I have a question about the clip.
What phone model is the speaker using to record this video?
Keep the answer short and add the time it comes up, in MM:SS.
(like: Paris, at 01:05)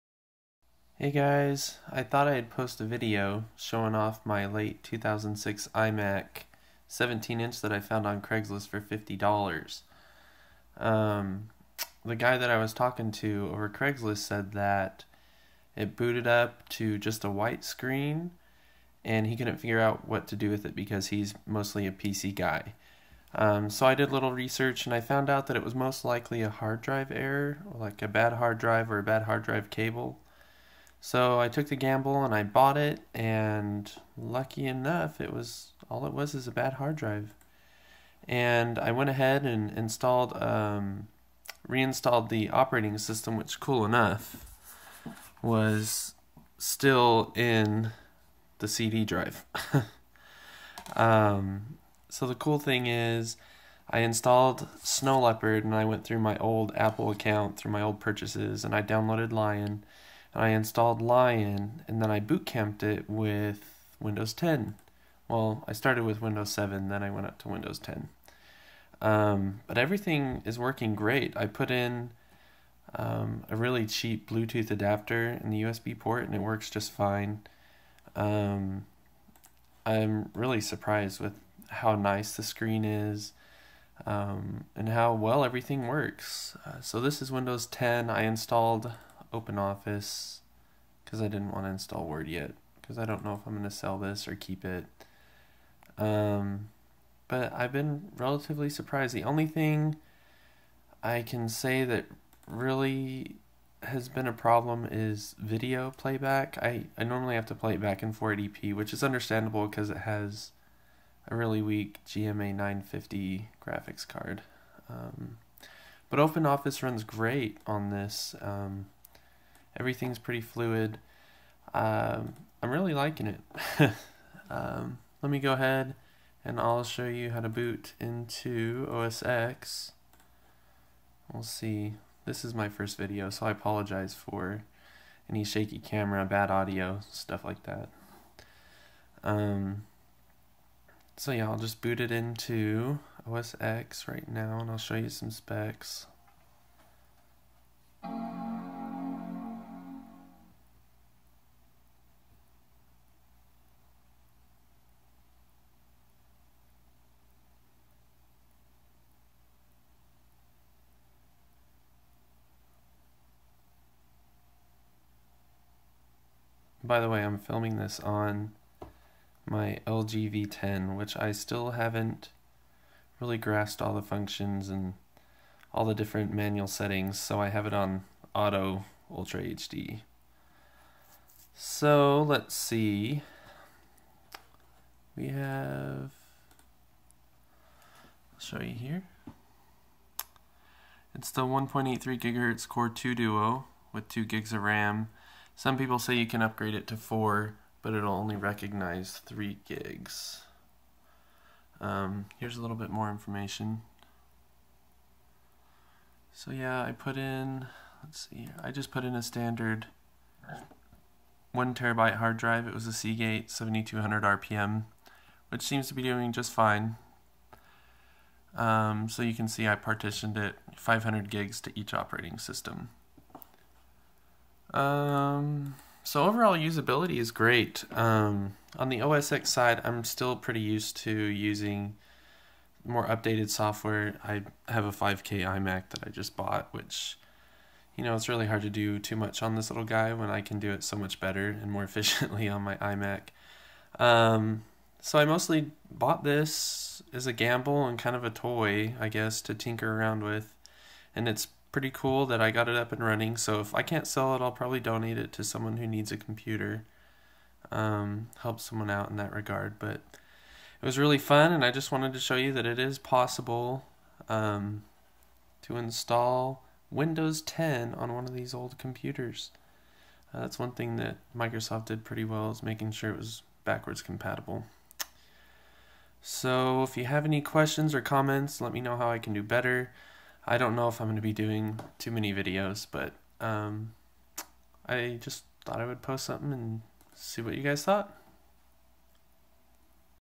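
LG V10, at 02:49.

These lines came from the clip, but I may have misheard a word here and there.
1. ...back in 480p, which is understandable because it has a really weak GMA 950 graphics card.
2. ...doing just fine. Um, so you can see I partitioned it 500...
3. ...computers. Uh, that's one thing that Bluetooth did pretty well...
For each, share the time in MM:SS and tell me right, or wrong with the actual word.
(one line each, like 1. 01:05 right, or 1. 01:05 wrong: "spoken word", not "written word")
1. 01:47 right
2. 03:36 right
3. 04:28 wrong: "Microsoft", not "Bluetooth".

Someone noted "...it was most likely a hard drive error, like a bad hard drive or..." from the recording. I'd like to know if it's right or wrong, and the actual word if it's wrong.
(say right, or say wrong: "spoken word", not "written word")
right.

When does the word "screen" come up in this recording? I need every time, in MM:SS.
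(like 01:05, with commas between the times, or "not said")
00:17, 01:22.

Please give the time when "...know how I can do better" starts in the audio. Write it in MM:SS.
04:38.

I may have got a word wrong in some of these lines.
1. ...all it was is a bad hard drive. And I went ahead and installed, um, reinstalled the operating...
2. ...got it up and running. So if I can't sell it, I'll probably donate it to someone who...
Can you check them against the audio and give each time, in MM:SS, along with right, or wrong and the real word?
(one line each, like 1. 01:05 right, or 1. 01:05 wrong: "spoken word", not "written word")
1. 00:35 right
2. 04:12 right.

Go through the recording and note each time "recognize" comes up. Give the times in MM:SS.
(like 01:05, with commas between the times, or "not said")
03:18.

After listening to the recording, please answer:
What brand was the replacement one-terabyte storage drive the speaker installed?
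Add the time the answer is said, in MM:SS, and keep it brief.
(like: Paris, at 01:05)
Seagate, at 03:32.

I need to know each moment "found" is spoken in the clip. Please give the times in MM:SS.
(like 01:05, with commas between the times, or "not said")
00:07, 00:24.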